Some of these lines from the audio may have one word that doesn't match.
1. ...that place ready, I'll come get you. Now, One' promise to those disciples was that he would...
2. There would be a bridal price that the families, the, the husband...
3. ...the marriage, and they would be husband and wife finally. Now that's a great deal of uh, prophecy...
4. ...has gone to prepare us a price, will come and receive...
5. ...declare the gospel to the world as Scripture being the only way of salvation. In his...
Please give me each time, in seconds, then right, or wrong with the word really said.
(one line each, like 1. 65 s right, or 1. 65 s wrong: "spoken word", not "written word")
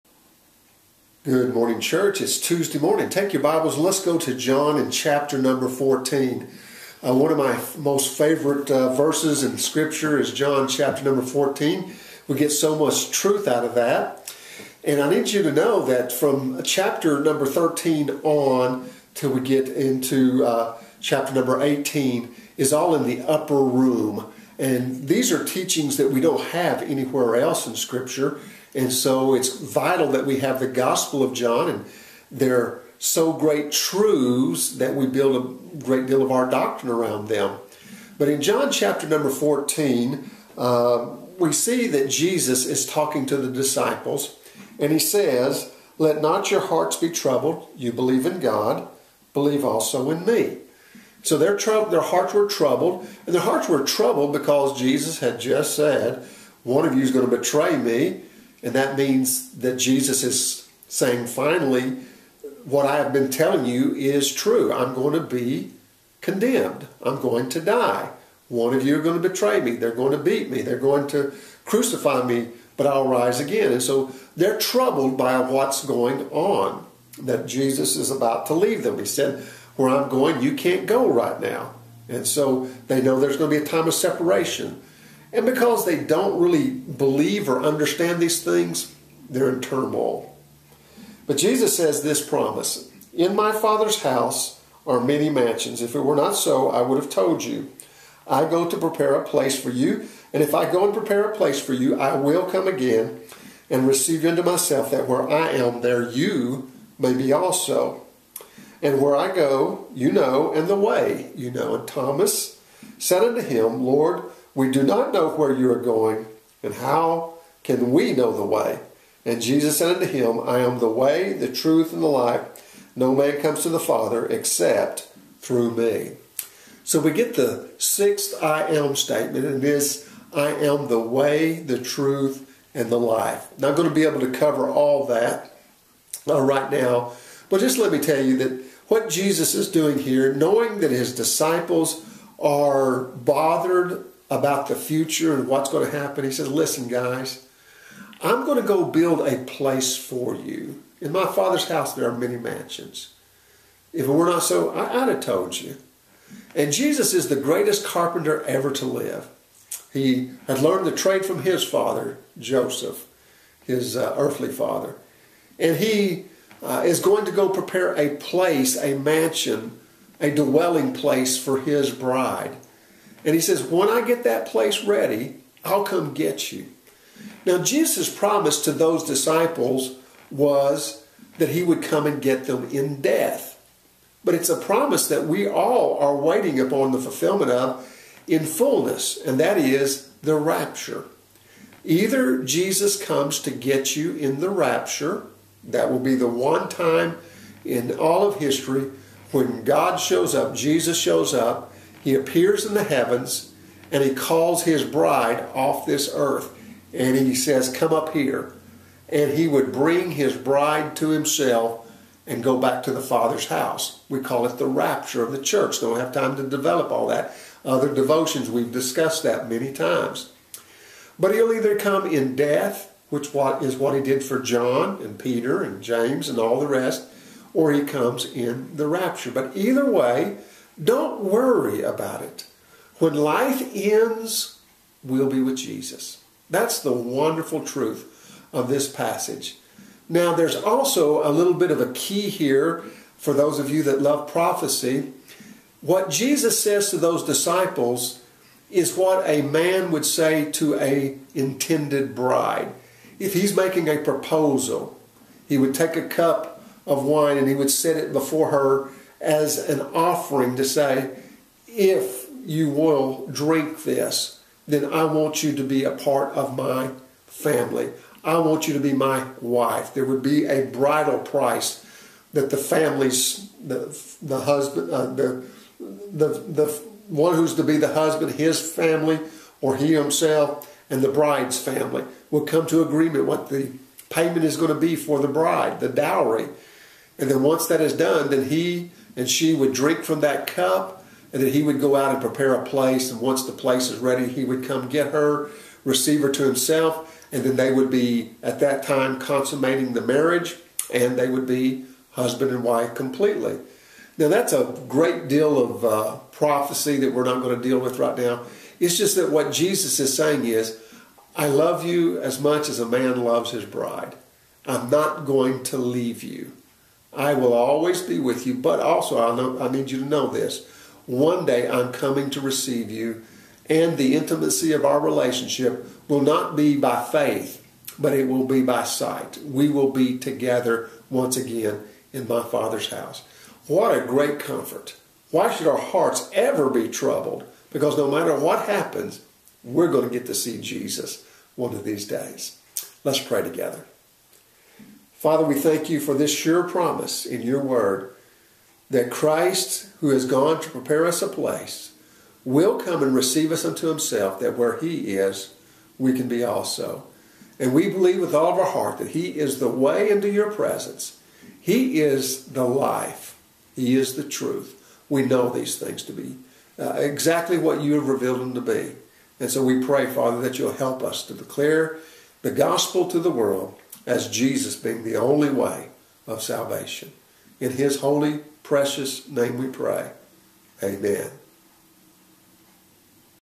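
1. 174 s wrong: "Jesus", not "One"
2. 269 s right
3. 299 s wrong: "completely", not "finally"
4. 350 s wrong: "place", not "price"
5. 371 s wrong: "Jesus", not "Scripture".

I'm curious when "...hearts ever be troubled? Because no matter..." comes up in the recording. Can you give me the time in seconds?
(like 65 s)
335 s.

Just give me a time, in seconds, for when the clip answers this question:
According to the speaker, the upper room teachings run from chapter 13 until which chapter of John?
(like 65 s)
21 s.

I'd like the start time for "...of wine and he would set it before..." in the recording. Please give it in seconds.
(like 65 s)
256 s.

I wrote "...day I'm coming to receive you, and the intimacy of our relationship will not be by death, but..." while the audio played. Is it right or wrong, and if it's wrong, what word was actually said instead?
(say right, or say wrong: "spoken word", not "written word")
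wrong: "faith", not "death".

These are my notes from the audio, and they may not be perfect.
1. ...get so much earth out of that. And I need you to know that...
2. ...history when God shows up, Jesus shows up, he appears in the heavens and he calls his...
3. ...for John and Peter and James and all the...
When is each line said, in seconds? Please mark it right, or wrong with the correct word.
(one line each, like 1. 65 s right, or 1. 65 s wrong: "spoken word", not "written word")
1. 12 s wrong: "truth", not "earth"
2. 198 s right
3. 224 s right.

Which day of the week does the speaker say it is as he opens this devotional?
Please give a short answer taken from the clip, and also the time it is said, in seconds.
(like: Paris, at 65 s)
Tuesday, at 2 s.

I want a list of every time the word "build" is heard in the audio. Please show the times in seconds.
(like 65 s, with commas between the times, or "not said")
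35 s, 148 s.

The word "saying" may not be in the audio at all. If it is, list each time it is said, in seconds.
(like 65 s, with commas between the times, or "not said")
60 s, 310 s.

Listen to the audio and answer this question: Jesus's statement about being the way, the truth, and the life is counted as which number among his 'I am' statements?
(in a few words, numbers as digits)
sixth.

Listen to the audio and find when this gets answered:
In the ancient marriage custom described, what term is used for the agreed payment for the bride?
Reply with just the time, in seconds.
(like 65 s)
285 s.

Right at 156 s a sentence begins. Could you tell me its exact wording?
And Jesus is the greatest carpenter ever to live.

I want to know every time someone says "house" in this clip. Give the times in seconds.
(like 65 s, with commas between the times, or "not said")
94 s, 151 s, 213 s, 332 s.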